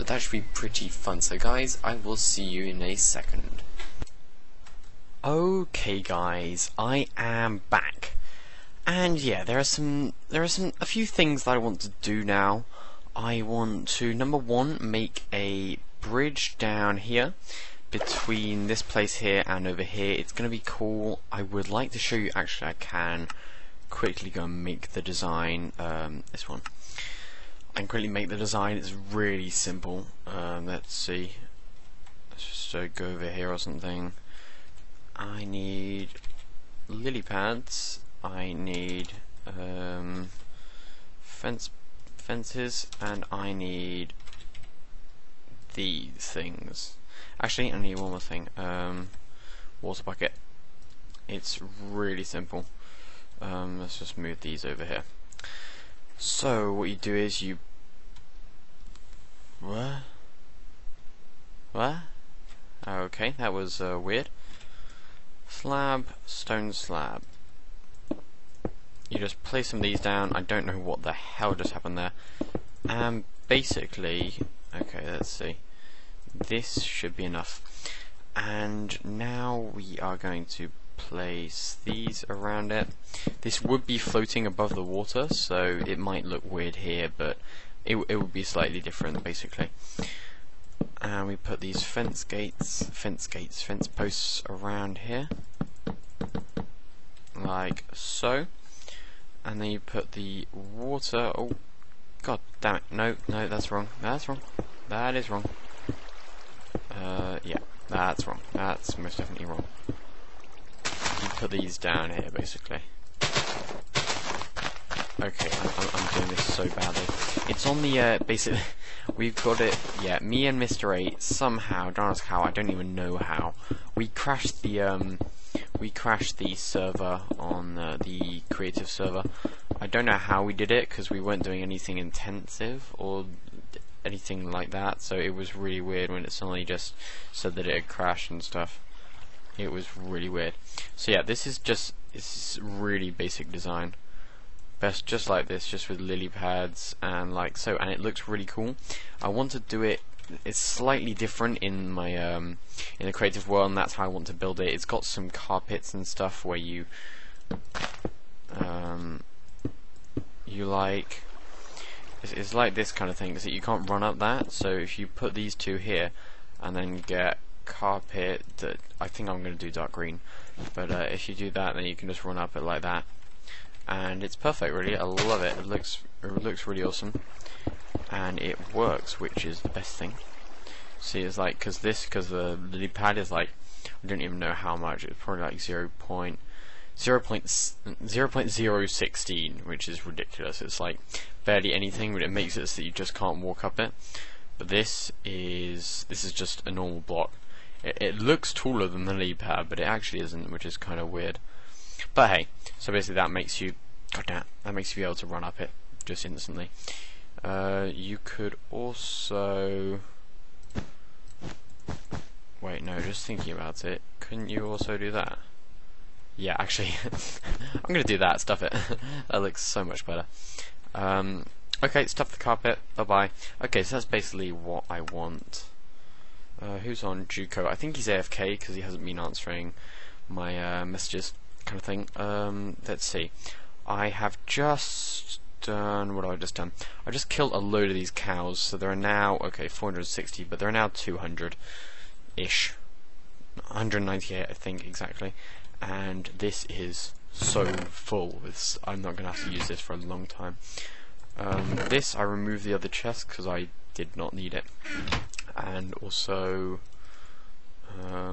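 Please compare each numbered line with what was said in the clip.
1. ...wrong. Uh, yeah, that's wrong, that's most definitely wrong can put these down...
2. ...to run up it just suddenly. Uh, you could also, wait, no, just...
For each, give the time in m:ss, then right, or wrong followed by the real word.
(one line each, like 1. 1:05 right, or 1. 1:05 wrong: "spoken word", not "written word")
1. 1:45 right
2. 3:25 wrong: "instantly", not "suddenly".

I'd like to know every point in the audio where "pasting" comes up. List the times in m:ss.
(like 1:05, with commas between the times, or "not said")
not said.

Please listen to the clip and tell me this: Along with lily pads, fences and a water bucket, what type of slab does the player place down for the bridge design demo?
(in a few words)
stone slab.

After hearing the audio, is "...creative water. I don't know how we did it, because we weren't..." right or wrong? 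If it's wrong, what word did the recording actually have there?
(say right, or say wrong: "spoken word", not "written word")
wrong: "server", not "water".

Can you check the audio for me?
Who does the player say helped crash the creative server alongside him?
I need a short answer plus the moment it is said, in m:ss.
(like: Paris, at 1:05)
Mr. 8, at 2:00.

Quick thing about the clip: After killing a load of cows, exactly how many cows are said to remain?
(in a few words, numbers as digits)
198.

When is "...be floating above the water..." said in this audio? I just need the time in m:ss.
1:23.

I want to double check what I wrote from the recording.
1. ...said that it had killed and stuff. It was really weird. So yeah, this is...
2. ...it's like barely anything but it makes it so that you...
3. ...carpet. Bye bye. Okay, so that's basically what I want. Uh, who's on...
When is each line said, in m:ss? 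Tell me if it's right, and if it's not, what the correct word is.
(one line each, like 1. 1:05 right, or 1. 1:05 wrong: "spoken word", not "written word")
1. 2:17 wrong: "crashed", not "killed"
2. 3:10 right
3. 3:42 right.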